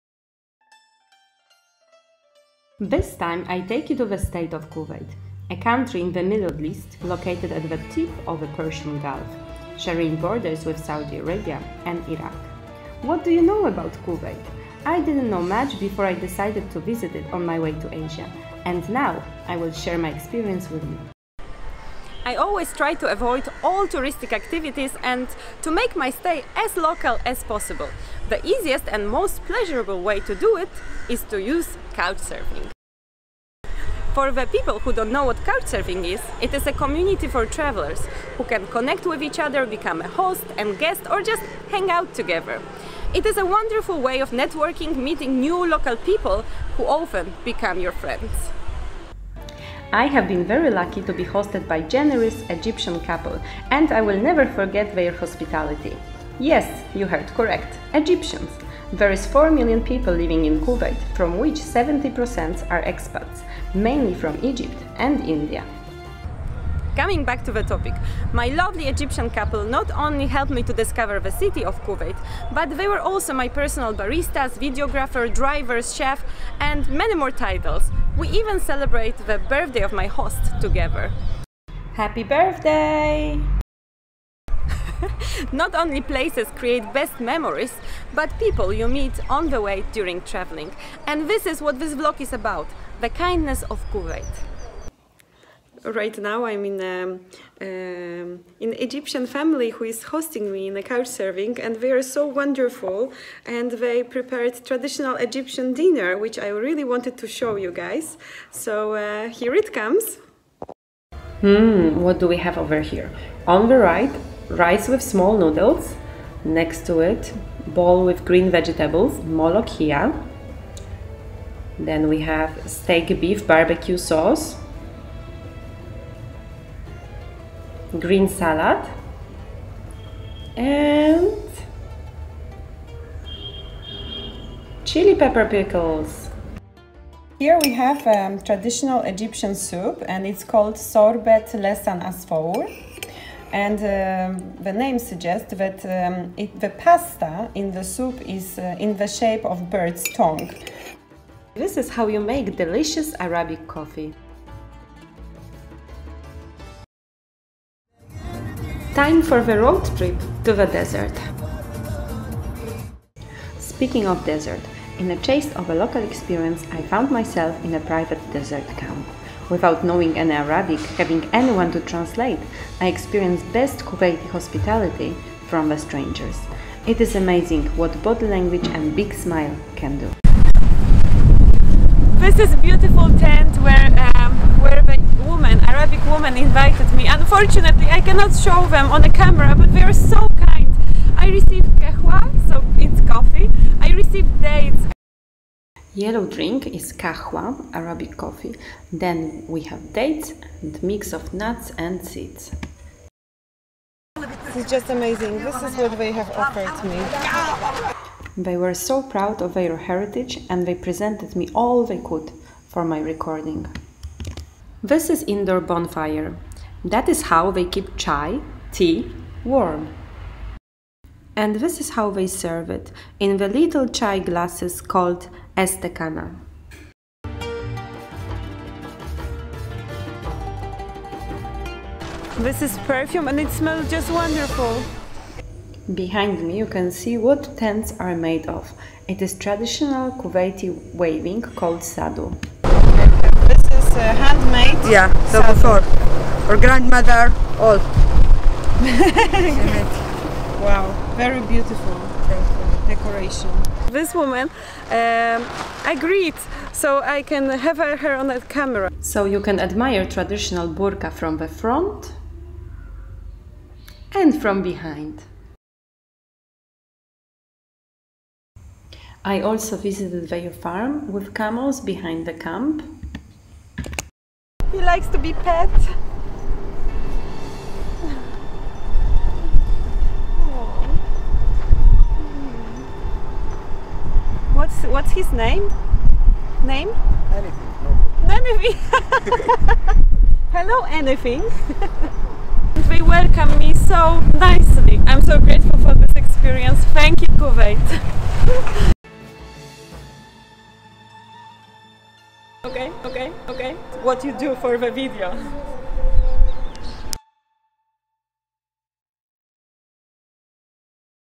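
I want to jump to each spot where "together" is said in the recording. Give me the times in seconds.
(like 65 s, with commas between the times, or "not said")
42 s, 80 s.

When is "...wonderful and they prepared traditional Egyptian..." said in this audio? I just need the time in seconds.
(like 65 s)
102 s.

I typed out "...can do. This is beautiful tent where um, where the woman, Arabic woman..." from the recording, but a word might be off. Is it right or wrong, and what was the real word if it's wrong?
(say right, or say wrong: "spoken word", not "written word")
right.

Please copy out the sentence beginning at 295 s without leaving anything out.
I'm so grateful for this experience.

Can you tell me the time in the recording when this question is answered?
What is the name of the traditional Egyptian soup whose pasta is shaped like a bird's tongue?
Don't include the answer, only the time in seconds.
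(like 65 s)
140 s.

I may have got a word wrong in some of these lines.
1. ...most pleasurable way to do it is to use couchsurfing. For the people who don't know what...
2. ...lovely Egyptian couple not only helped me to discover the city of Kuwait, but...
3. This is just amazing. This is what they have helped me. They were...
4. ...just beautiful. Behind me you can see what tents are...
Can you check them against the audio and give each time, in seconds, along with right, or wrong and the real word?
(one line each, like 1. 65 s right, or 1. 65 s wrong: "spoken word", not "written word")
1. 29 s right
2. 68 s right
3. 204 s wrong: "offered", not "helped"
4. 233 s wrong: "wonderful", not "beautiful".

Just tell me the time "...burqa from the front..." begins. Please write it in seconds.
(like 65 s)
260 s.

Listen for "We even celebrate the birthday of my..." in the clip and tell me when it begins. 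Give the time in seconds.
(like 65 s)
78 s.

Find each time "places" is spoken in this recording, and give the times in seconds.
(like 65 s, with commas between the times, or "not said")
86 s.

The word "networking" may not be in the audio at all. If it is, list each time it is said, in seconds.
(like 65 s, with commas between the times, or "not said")
44 s.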